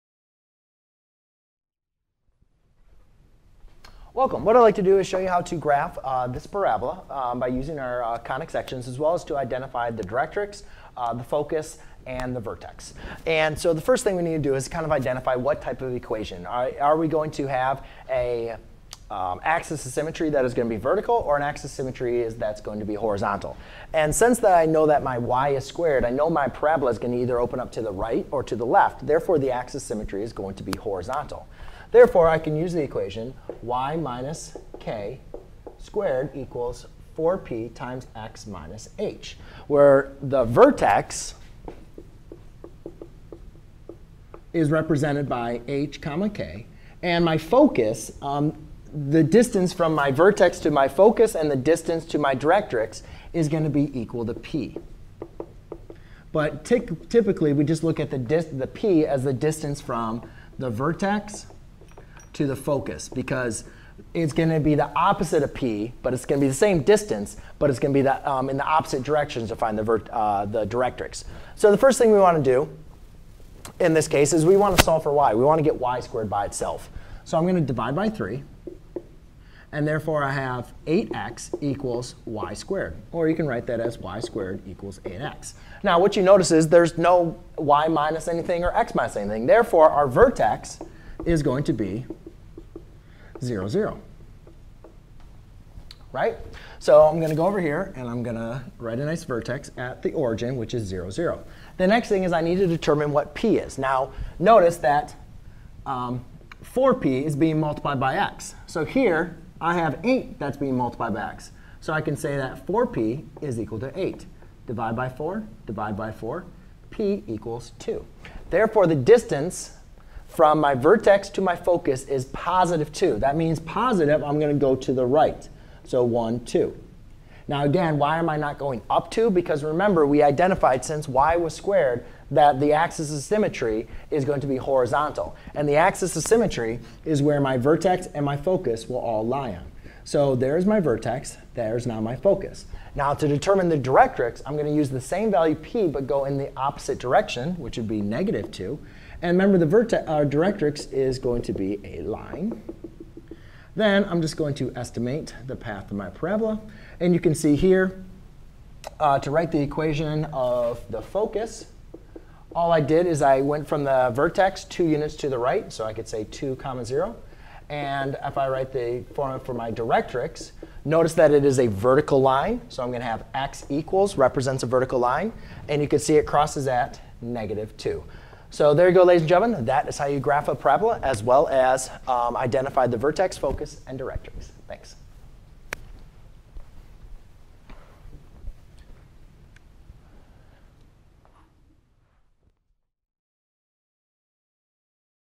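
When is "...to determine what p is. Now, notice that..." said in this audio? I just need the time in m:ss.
1:42.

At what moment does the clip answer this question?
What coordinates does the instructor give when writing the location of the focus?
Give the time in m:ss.
2:46.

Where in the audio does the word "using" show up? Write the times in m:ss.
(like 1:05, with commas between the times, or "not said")
0:07.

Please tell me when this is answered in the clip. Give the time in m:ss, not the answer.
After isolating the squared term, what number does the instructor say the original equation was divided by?
1:17.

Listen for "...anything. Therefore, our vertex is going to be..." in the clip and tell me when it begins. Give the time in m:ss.
1:29.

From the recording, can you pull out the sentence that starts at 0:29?
Therefore, the axis symmetry is going to be horizontal.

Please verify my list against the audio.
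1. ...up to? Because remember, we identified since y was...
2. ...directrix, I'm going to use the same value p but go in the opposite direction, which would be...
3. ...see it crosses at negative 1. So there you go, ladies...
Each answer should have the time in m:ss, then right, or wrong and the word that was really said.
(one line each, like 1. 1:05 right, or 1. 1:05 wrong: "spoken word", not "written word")
1. 2:08 right
2. 2:23 right
3. 2:55 wrong: "2", not "1".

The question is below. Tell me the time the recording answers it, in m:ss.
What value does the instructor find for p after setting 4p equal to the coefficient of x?
1:56.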